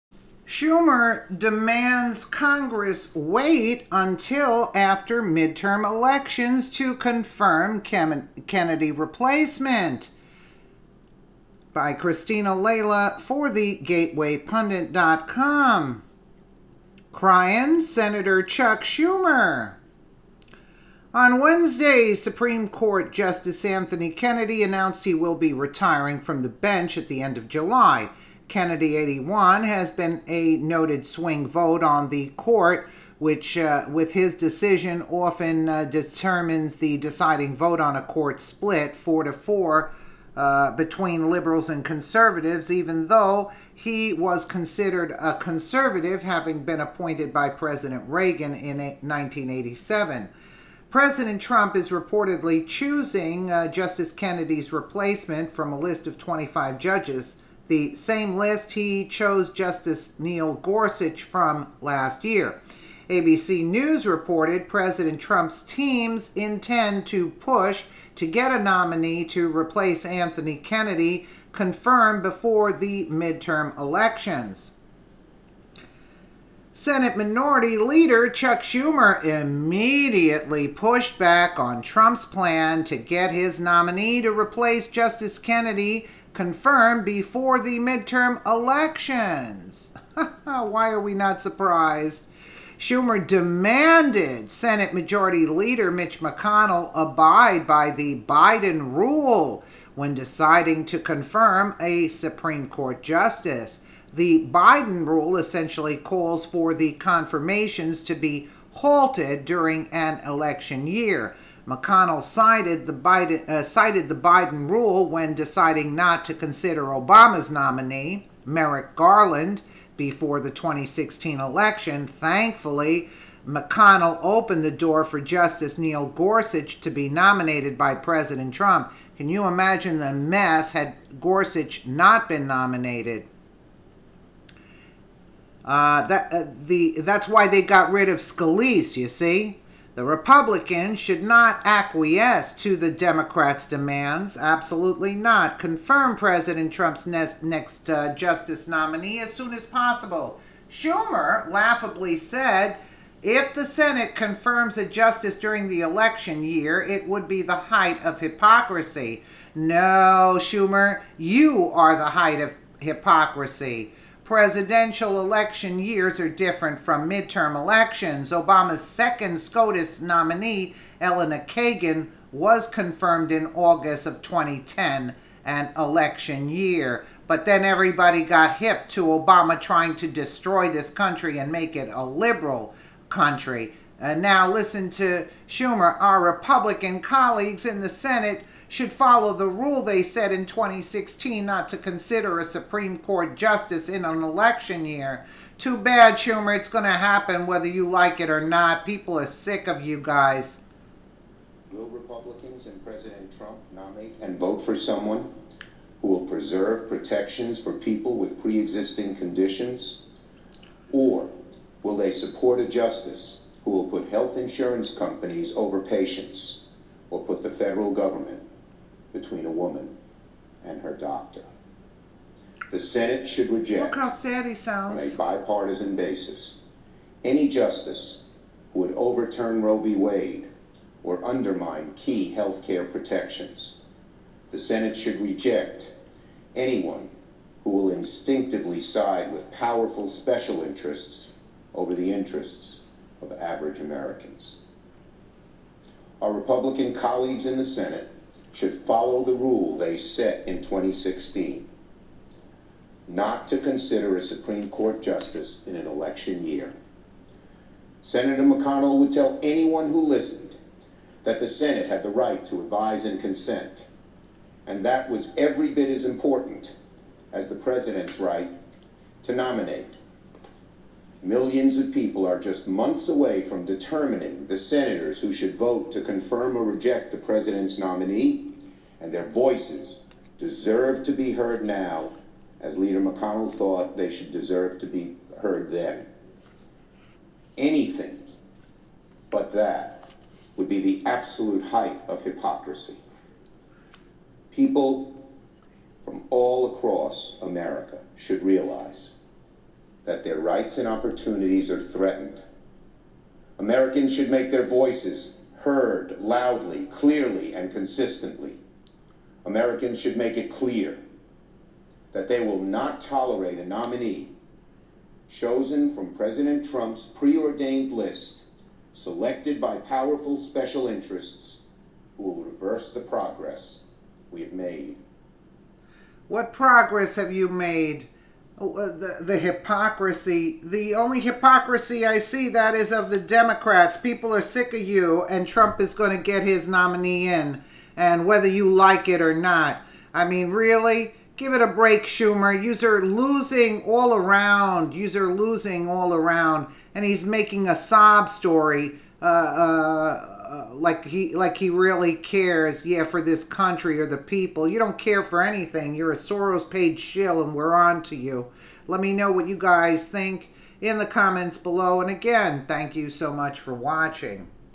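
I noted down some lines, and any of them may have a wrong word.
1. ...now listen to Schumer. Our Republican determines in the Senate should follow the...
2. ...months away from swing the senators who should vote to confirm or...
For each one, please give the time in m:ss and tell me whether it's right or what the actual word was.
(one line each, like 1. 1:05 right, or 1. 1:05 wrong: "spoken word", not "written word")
1. 3:04 wrong: "colleagues", not "determines"
2. 4:32 wrong: "determining", not "swing".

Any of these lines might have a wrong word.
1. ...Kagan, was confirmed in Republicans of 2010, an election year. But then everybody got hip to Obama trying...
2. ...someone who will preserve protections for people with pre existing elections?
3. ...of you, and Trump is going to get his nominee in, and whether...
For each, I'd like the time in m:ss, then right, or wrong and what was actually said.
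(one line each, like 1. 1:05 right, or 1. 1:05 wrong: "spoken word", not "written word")
1. 2:51 wrong: "August", not "Republicans"
2. 3:24 wrong: "conditions", not "elections"
3. 5:34 right.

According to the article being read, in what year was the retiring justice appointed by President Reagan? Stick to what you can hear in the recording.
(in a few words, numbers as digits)
1987.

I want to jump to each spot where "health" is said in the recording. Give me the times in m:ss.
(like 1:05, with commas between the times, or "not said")
3:34, 3:52.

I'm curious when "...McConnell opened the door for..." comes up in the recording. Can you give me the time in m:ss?
2:03.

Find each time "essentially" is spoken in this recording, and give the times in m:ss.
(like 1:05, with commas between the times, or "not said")
1:45.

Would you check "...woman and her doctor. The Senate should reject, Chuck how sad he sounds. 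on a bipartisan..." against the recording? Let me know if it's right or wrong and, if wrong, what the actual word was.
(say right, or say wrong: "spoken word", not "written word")
wrong: "Look", not "Chuck".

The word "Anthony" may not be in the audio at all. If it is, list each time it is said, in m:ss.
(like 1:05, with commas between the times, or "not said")
0:23, 1:10.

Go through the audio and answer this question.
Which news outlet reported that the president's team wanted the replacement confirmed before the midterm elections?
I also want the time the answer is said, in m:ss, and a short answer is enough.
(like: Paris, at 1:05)
ABC News, at 1:03.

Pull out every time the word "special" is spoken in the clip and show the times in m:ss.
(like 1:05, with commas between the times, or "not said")
4:00, 5:20.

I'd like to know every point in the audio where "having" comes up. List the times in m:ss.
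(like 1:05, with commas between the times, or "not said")
0:46.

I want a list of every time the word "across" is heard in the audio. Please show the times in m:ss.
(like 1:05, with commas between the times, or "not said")
4:56.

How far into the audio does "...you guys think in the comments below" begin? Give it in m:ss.
5:59.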